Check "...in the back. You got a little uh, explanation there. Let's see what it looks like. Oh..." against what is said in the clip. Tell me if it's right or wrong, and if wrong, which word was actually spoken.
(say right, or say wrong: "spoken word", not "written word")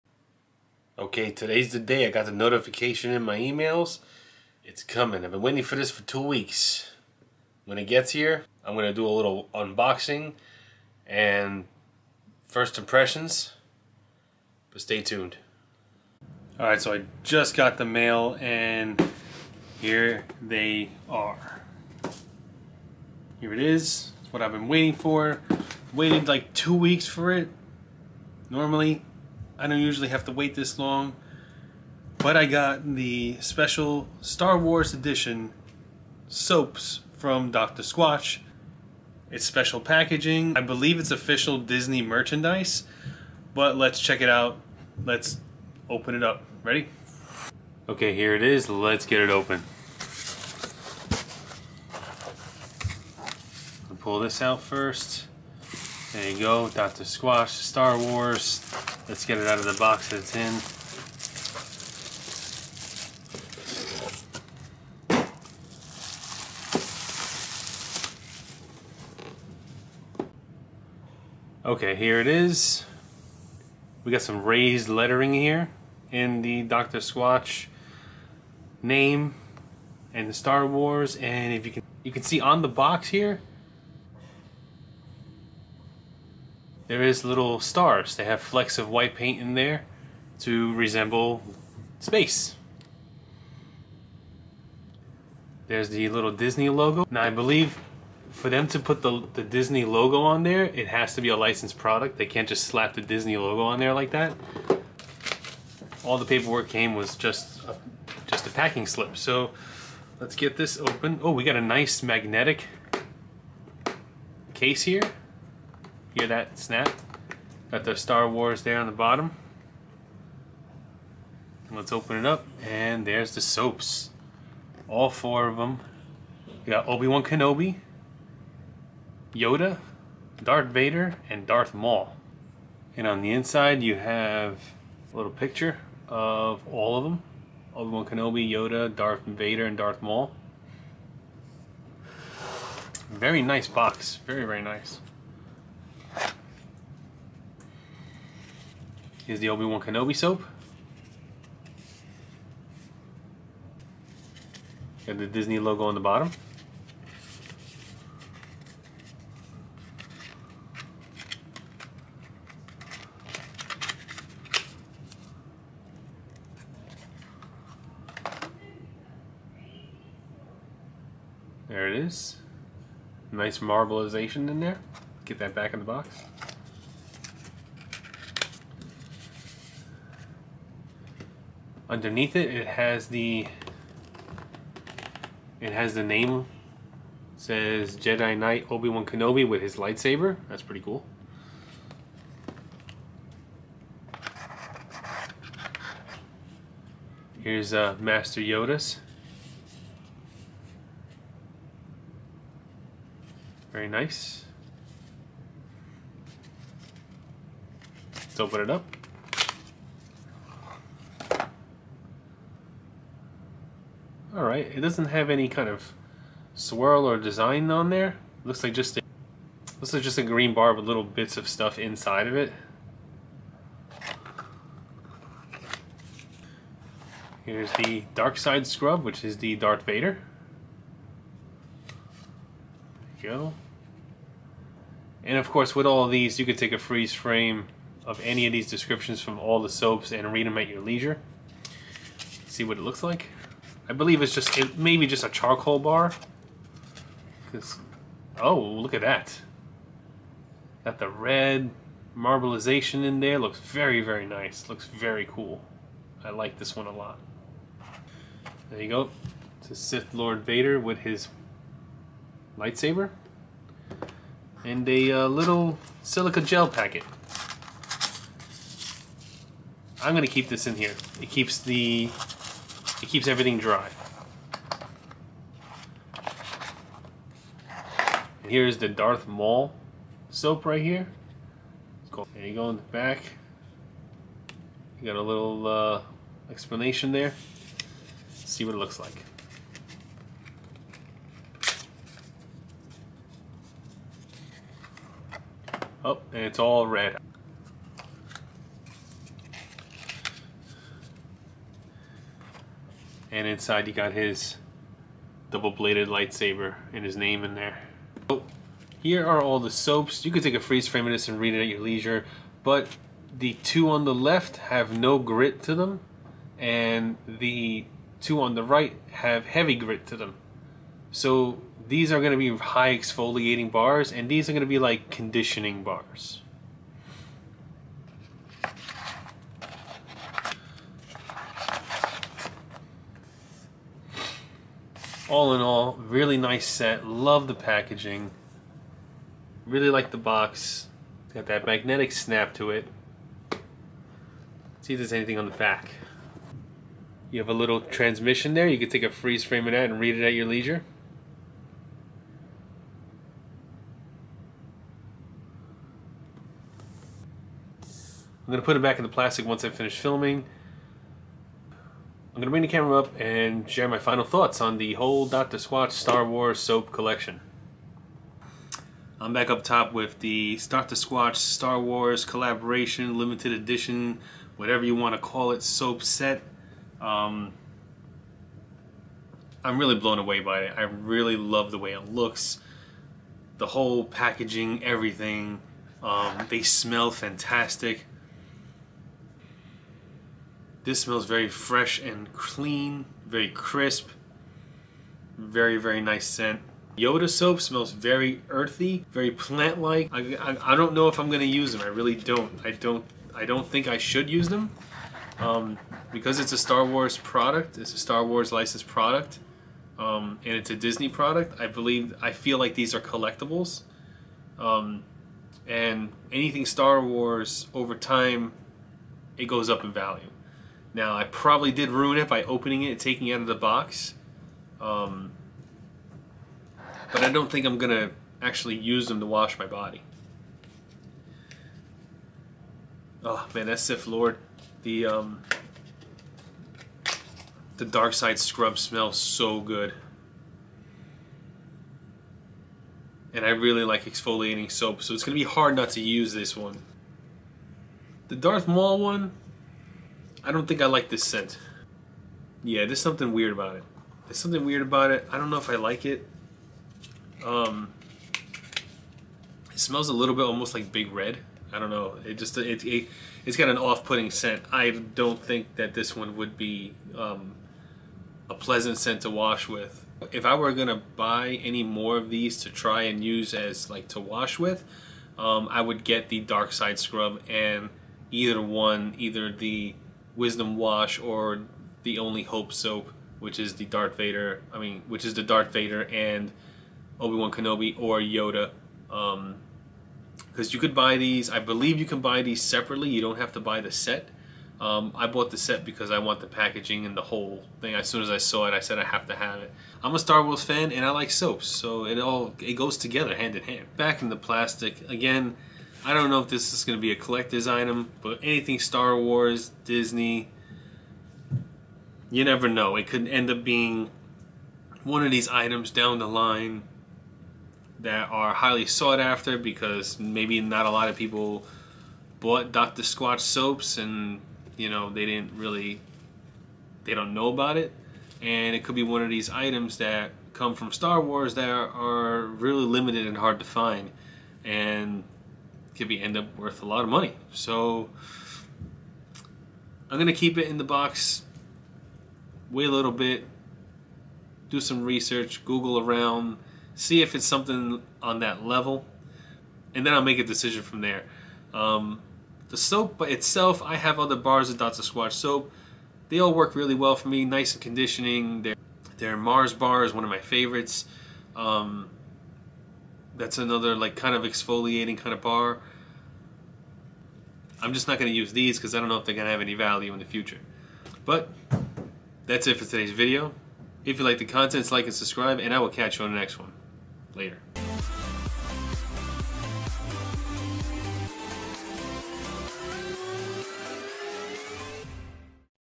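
right.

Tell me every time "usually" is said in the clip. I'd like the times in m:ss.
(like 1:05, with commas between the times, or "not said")
0:29.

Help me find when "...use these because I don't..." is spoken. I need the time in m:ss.
9:28.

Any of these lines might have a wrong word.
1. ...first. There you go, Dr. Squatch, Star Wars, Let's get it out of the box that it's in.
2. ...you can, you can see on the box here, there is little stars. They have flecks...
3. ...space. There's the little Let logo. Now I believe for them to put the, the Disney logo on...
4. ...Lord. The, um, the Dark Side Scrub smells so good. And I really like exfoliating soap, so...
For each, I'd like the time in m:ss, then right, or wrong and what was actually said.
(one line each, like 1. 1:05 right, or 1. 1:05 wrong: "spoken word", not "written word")
1. 0:54 right
2. 1:21 right
3. 1:32 wrong: "Disney", not "Let"
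4. 7:14 right.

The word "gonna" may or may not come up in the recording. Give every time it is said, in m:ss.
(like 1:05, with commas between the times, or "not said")
6:41, 7:50, 9:00.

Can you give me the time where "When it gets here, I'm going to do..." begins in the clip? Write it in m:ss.
0:07.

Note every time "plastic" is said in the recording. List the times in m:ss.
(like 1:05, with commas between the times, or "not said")
5:59, 8:24.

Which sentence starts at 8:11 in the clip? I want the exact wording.
I believe you can buy these separately.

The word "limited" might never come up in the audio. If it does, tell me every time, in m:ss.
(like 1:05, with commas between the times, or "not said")
6:13, 8:52.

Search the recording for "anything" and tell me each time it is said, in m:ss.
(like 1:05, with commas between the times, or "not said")
5:45, 6:56, 8:28.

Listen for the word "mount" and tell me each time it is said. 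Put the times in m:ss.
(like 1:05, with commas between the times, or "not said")
not said.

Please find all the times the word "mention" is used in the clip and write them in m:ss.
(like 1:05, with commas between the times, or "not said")
not said.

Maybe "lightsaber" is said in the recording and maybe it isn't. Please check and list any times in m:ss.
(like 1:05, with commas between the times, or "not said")
3:09, 4:22, 5:06.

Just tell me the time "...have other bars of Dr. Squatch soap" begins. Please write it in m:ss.
9:13.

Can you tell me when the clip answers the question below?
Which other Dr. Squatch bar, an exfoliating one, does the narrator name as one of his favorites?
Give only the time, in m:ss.
9:19.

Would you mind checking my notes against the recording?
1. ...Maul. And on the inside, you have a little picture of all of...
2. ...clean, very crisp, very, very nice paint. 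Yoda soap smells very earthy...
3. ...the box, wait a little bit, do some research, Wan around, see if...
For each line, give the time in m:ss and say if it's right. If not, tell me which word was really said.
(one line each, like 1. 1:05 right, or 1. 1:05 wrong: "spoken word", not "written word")
1. 2:11 right
2. 6:32 wrong: "scent", not "paint"
3. 9:00 wrong: "Google", not "Wan".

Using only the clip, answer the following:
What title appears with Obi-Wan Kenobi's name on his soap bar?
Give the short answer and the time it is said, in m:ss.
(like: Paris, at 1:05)
Jedi Knight, at 3:07.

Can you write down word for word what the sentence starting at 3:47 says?
Here's the Dark Side Scrub, which is the Darth Vader.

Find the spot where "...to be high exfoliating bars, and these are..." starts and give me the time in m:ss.
5:22.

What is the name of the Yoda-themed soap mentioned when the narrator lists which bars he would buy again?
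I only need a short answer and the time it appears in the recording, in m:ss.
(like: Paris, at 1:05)
Wisdom Wash, at 8:00.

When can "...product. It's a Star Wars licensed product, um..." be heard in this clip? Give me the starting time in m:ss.
6:47.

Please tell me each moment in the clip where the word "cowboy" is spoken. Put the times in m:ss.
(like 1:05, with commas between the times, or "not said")
not said.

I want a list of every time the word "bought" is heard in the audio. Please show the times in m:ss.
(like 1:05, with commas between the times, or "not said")
8:15, 8:42.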